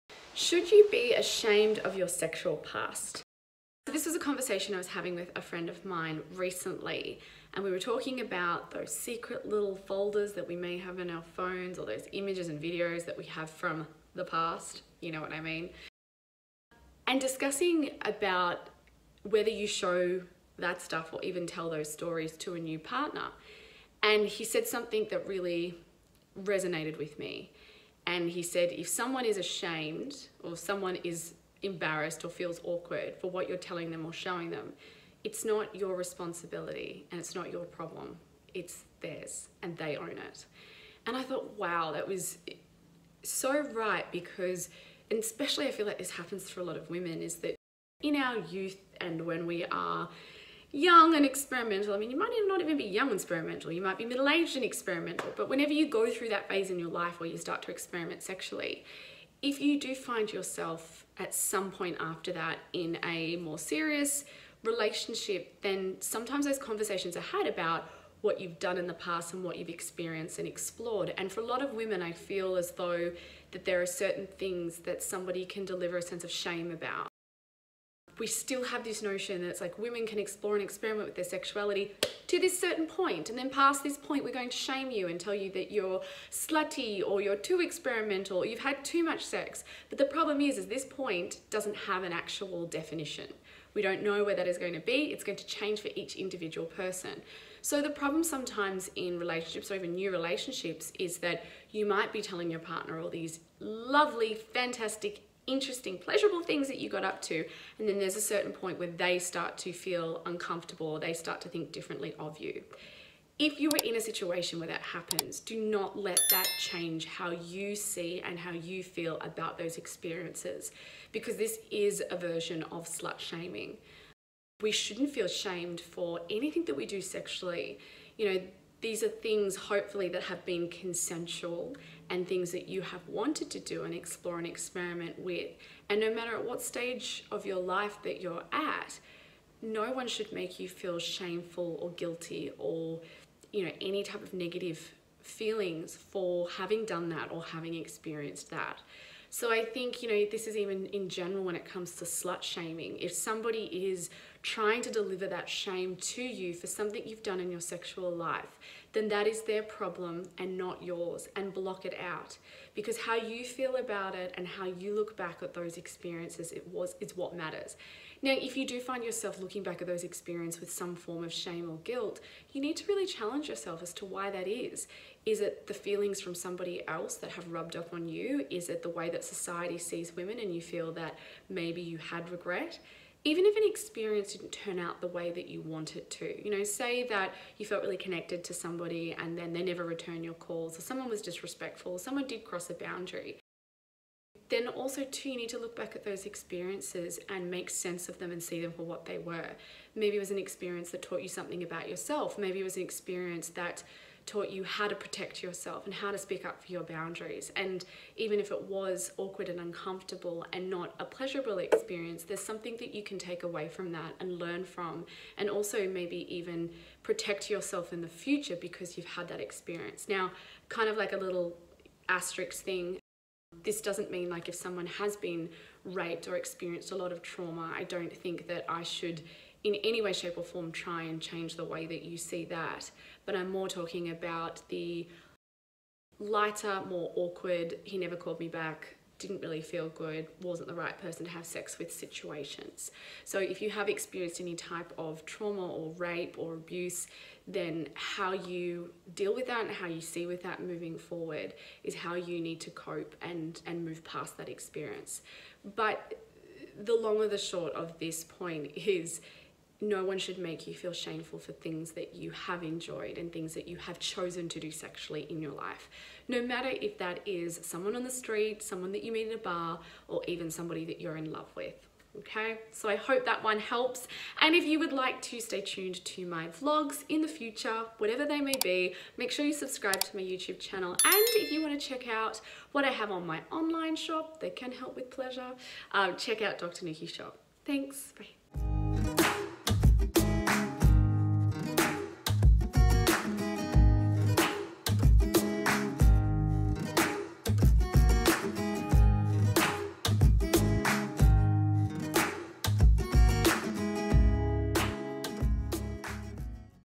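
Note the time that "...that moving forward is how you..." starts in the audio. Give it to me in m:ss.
4:10.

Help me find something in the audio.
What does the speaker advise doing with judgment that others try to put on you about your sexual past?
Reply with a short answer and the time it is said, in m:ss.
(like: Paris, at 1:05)
block it out, at 2:41.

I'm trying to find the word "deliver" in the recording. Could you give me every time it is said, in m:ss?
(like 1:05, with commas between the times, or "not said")
1:15, 2:34.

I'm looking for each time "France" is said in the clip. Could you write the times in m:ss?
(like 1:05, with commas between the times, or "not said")
not said.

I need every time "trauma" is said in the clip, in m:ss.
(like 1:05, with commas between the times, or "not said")
3:47, 4:05.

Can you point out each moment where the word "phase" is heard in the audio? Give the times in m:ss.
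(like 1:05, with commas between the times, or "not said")
0:56.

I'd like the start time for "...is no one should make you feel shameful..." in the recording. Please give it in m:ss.
4:18.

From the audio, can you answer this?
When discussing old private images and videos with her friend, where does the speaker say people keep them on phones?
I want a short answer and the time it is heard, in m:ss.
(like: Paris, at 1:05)
secret little folders, at 0:08.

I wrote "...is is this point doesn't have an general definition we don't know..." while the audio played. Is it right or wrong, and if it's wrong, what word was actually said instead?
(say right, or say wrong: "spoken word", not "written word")
wrong: "actual", not "general".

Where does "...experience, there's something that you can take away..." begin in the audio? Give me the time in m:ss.
3:31.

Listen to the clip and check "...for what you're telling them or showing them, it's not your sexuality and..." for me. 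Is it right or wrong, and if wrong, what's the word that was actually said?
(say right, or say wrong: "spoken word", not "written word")
wrong: "responsibility", not "sexuality".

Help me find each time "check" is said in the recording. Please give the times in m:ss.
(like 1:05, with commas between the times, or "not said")
4:41, 4:46.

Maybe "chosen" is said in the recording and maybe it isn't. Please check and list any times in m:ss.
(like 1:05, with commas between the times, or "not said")
4:23.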